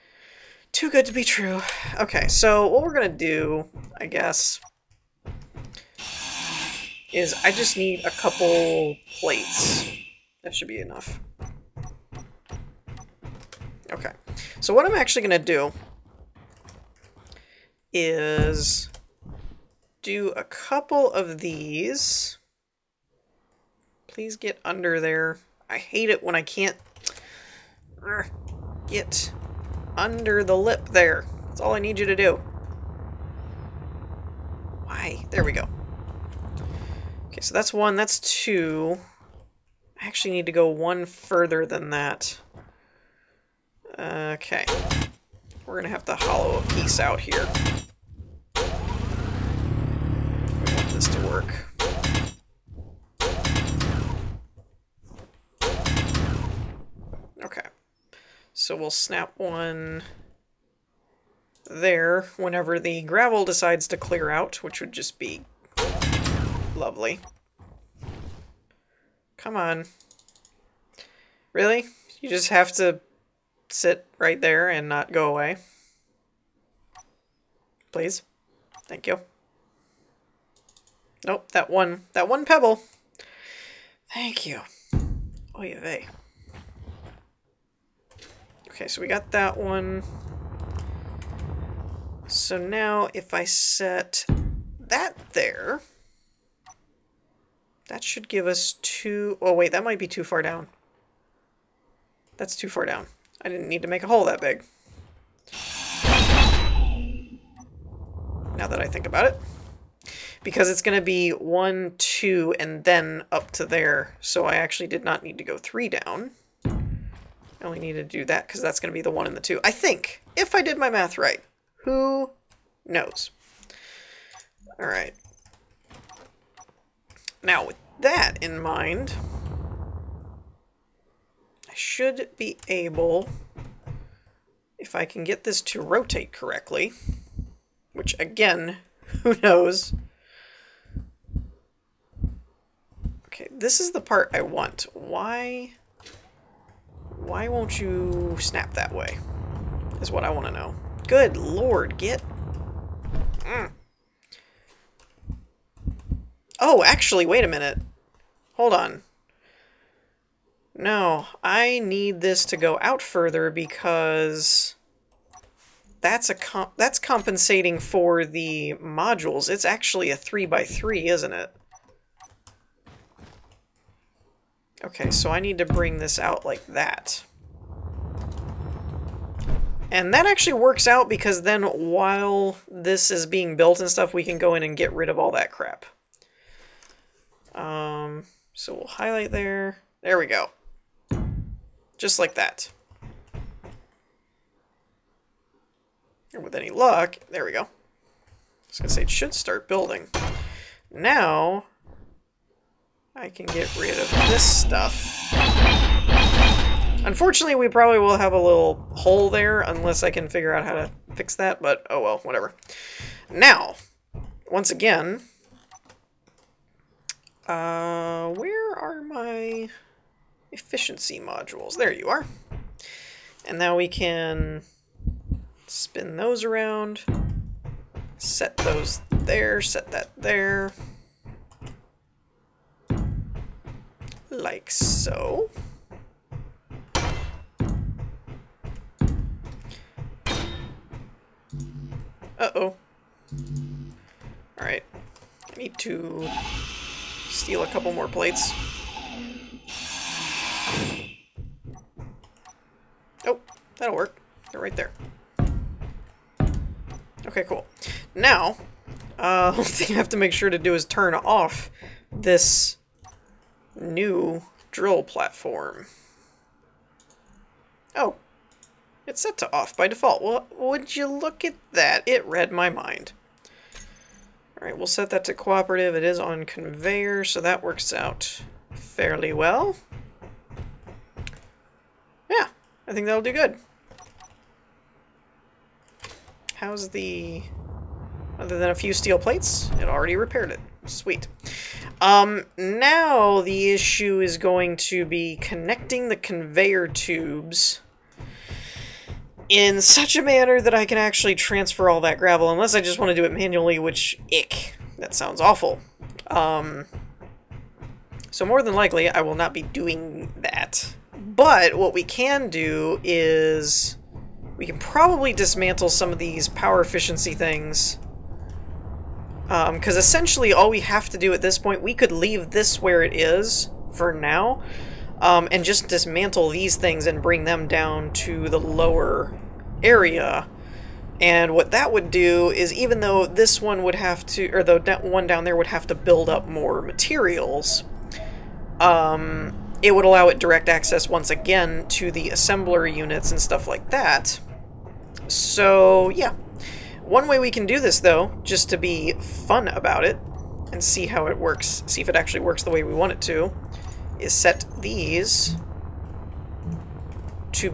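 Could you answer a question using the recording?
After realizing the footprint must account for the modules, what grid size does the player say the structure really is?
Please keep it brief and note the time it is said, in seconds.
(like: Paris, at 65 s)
3 by 3, at 170 s.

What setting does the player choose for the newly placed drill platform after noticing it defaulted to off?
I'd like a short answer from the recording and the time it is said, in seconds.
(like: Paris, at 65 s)
cooperative, at 275 s.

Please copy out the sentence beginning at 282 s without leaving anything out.
Yeah, I think that'll do good how's the...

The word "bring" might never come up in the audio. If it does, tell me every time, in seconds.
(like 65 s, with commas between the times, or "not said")
175 s, 327 s.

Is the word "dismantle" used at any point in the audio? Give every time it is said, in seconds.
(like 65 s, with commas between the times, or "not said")
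315 s, 325 s.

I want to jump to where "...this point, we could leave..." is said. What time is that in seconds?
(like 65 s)
321 s.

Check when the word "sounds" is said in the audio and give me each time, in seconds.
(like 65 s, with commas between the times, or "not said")
305 s.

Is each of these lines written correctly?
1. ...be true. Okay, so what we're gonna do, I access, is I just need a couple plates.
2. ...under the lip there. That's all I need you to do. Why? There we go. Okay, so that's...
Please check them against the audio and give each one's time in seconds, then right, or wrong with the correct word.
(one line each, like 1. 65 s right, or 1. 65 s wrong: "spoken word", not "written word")
1. 1 s wrong: "guess", not "access"
2. 29 s right.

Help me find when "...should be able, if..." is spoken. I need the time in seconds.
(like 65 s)
131 s.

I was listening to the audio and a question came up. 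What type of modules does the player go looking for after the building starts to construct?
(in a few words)
efficiency modules.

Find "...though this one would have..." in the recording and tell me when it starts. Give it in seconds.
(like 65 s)
332 s.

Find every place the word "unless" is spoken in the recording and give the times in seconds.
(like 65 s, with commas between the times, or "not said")
209 s, 302 s.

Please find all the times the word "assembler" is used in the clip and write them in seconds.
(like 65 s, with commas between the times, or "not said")
342 s.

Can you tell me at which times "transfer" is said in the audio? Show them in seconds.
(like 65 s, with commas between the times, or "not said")
301 s.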